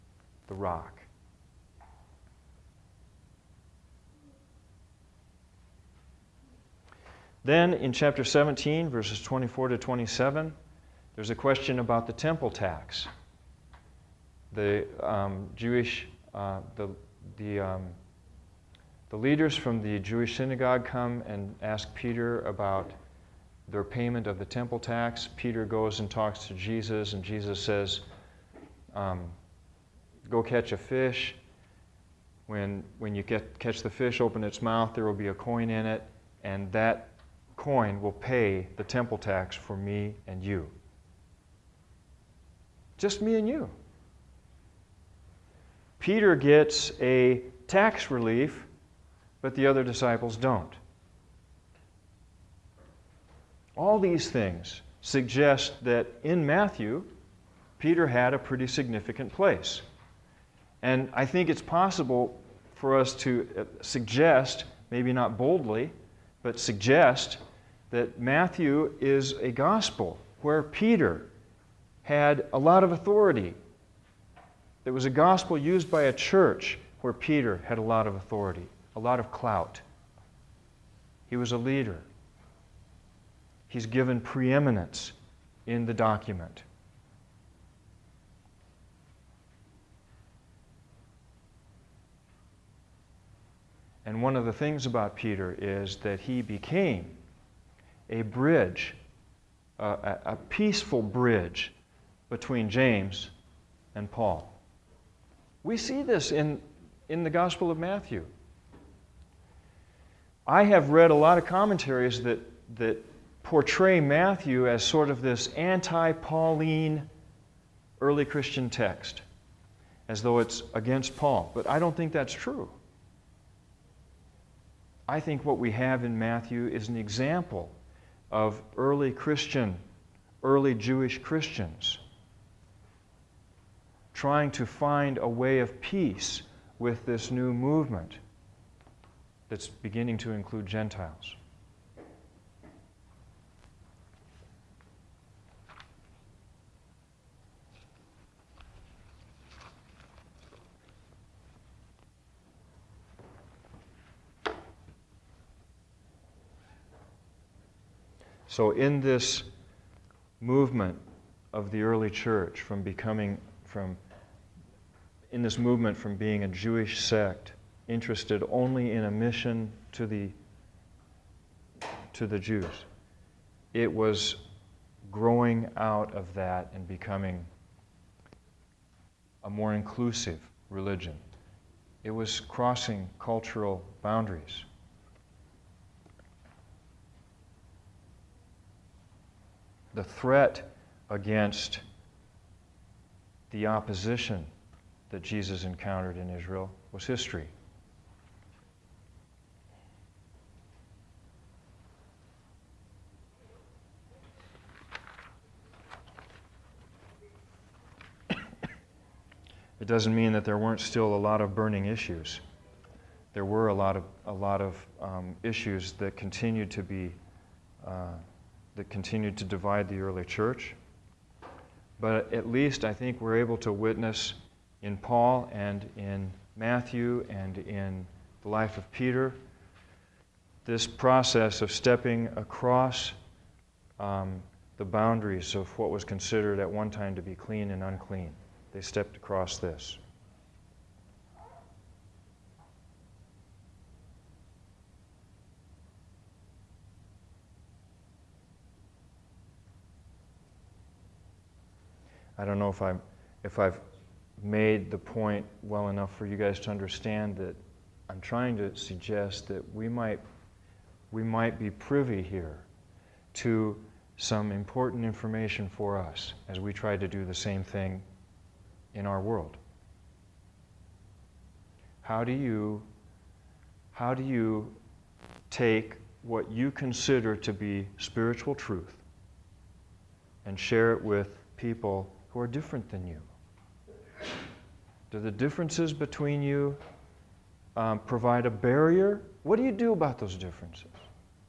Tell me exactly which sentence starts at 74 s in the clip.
It was a gospel used by a church where Peter had a lot of authority, a lot of clout.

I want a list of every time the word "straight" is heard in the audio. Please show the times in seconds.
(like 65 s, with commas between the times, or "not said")
not said.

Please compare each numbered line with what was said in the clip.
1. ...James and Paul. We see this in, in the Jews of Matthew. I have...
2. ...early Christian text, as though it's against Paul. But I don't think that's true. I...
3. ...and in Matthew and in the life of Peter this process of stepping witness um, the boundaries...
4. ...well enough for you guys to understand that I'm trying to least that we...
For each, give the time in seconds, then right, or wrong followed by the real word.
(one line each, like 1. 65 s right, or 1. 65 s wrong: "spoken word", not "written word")
1. 102 s wrong: "Gospel", not "Jews"
2. 118 s right
3. 225 s wrong: "across", not "witness"
4. 255 s wrong: "suggest", not "least".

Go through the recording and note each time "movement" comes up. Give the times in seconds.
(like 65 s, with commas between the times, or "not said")
137 s, 160 s, 165 s.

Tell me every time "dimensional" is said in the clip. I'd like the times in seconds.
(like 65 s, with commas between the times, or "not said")
not said.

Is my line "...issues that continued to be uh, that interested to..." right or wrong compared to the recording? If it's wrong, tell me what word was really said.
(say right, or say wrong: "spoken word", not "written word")
wrong: "continued", not "interested".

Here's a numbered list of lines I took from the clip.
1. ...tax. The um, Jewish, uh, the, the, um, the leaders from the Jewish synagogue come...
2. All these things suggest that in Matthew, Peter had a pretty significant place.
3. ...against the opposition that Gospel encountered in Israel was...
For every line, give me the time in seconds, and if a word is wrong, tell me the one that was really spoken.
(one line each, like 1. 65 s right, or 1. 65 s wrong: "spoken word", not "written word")
1. 12 s right
2. 53 s right
3. 191 s wrong: "Jesus", not "Gospel".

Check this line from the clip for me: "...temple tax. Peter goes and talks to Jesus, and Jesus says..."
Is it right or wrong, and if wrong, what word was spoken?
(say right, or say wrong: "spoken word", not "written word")
right.